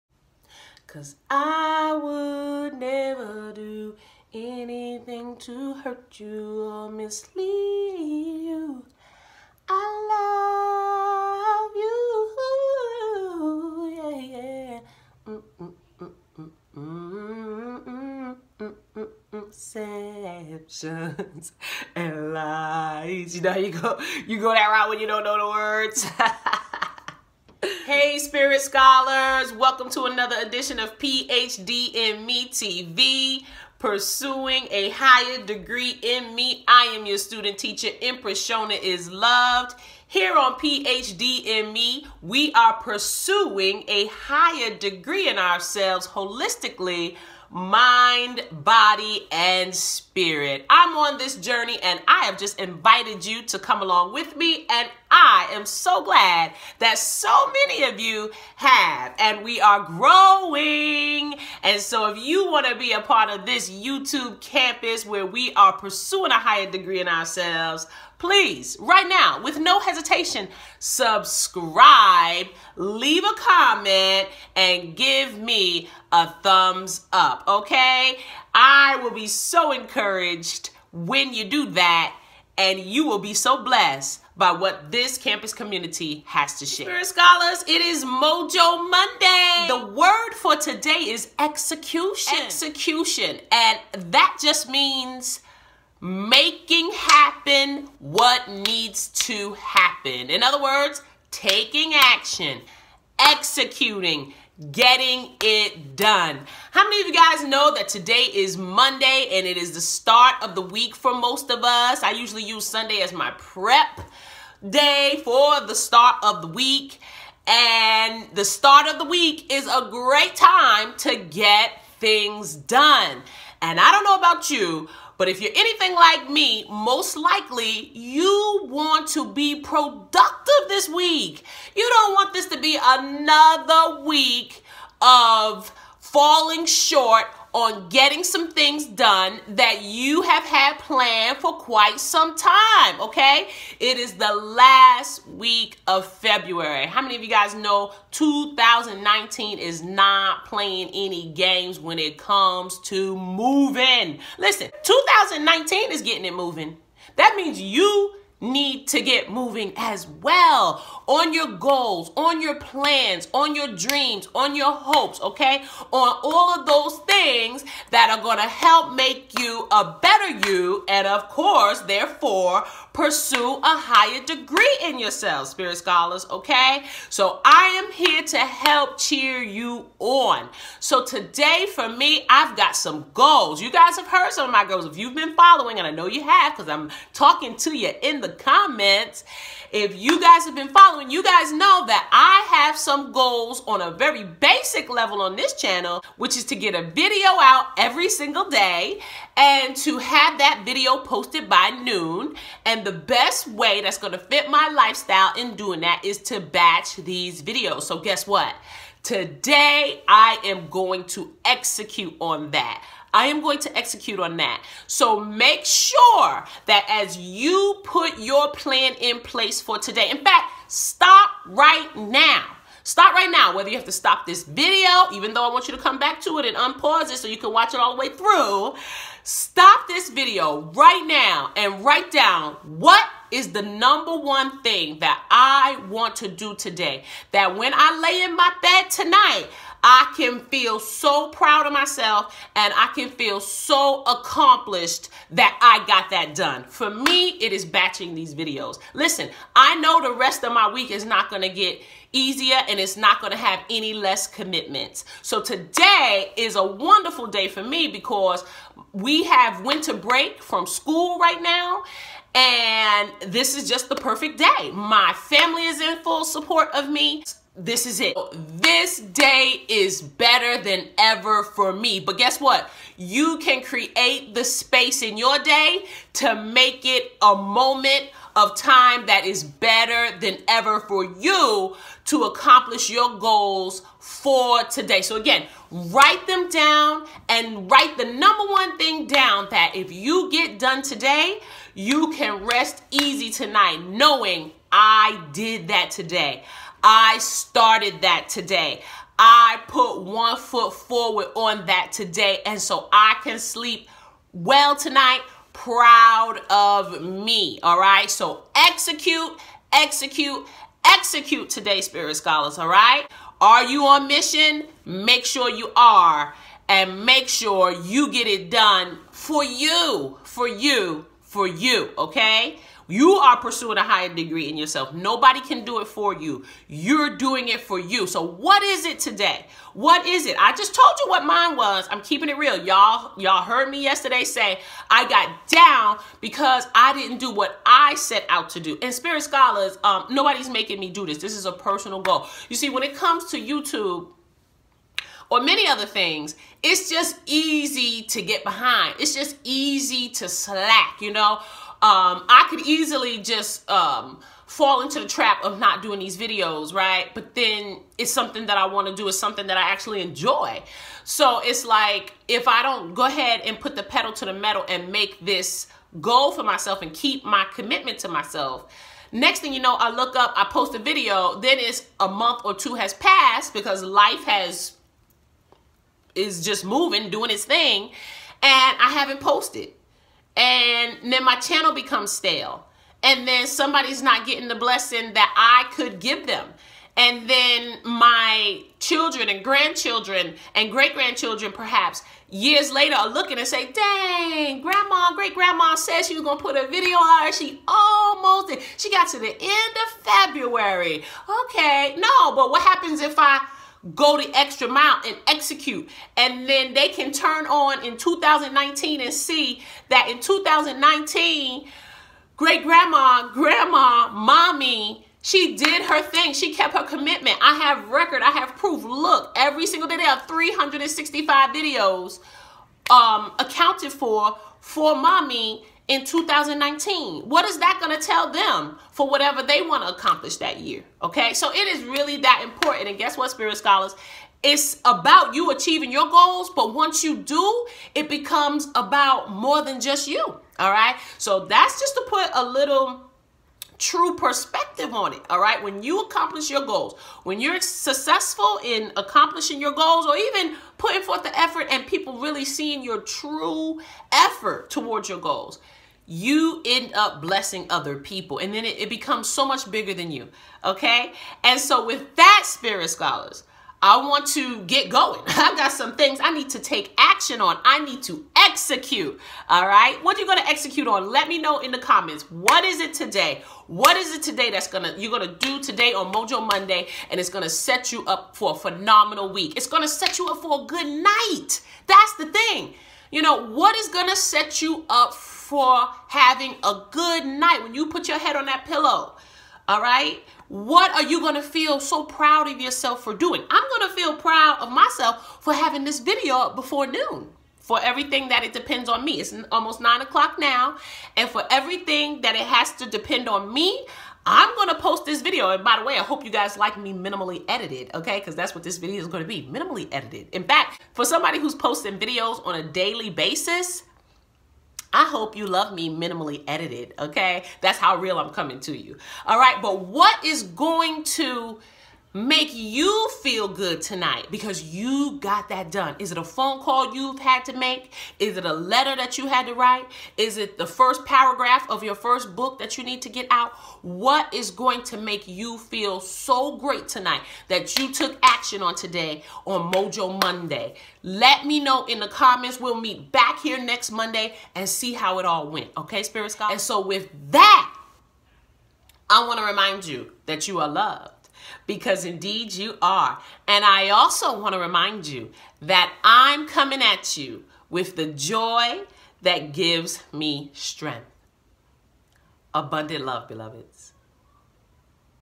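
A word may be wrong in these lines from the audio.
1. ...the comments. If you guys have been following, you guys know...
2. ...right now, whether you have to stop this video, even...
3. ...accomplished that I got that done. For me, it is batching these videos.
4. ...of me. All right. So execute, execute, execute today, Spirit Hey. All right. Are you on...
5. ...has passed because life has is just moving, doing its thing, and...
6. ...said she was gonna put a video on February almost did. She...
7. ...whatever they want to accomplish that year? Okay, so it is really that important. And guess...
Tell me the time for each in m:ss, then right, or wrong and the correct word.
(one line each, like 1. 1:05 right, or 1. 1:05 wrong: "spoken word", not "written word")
1. 3:08 right
2. 3:43 right
3. 4:04 right
4. 5:06 wrong: "Scholars", not "Hey"
5. 6:12 right
6. 6:35 wrong: "She", not "February"
7. 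7:09 right.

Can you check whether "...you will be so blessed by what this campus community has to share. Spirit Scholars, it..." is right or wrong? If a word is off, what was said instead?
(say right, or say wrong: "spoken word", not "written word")
right.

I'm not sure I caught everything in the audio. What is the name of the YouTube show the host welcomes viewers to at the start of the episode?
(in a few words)
PhD in Me TV.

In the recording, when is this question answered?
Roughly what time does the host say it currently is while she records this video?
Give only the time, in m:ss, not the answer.
8:19.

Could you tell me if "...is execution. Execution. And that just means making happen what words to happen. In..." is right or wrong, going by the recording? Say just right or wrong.
wrong.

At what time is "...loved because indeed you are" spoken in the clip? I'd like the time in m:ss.
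9:10.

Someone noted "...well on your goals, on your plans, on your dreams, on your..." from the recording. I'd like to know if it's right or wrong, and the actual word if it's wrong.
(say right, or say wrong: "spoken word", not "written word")
right.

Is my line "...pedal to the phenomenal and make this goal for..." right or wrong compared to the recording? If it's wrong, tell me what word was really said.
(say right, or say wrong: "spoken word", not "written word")
wrong: "metal", not "phenomenal".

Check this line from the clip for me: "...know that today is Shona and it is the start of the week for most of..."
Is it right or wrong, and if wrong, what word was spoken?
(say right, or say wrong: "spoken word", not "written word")
wrong: "Monday", not "Shona".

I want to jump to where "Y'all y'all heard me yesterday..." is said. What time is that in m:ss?
5:32.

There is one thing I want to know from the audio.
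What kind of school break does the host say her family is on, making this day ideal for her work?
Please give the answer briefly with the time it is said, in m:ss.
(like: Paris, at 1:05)
Winter break, at 4:19.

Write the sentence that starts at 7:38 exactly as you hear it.
And then it, it becomes so much bigger than you.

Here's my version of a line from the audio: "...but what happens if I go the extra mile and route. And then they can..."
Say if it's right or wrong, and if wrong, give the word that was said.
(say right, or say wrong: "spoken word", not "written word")
wrong: "execute", not "route".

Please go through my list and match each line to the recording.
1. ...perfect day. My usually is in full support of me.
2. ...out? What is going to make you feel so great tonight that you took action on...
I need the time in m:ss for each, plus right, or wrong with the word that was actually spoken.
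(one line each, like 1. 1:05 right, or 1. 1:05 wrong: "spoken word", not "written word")
1. 4:23 wrong: "family", not "usually"
2. 8:53 right.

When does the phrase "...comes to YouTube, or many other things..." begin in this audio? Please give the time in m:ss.
5:42.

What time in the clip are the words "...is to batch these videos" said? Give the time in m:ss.
3:26.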